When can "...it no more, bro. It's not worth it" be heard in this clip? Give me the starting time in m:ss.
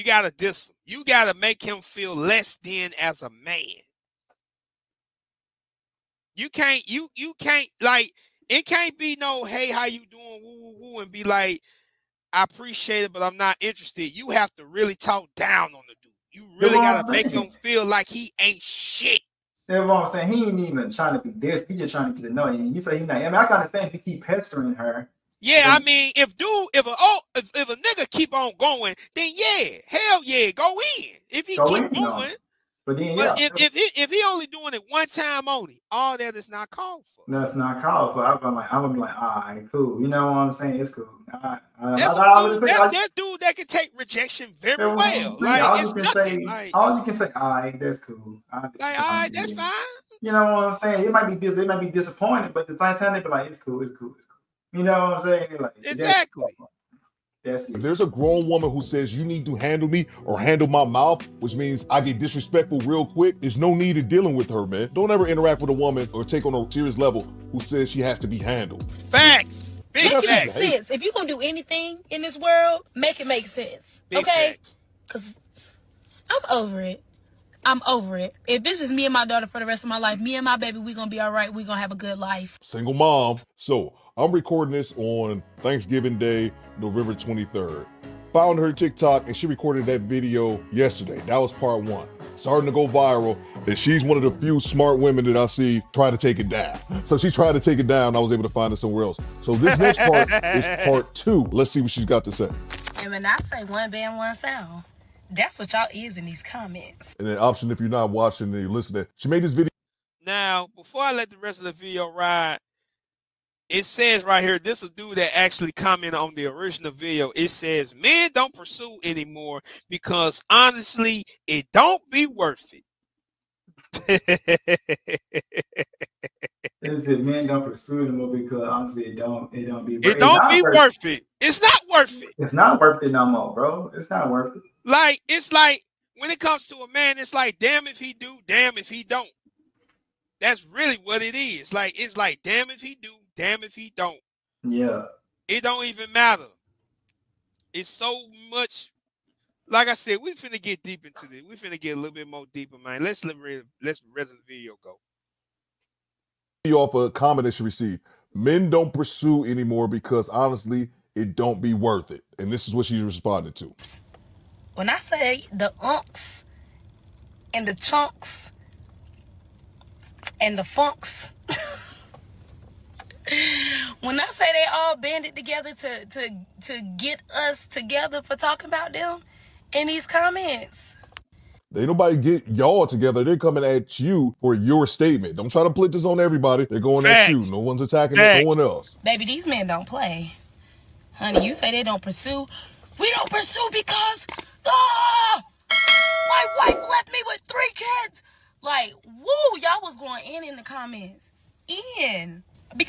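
2:13.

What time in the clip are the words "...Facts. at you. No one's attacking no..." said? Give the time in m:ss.
3:07.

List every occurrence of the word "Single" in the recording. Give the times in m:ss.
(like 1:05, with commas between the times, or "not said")
1:22.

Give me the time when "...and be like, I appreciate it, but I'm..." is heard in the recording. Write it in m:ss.
0:10.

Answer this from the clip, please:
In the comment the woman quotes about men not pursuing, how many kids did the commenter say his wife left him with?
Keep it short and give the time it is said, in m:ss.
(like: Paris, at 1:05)
3, at 3:17.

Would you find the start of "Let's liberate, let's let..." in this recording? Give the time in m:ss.
2:33.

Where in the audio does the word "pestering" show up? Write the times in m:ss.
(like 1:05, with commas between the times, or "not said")
0:24.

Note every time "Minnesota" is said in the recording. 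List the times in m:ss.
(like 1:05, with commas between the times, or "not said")
not said.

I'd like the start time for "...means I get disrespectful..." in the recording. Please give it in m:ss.
1:01.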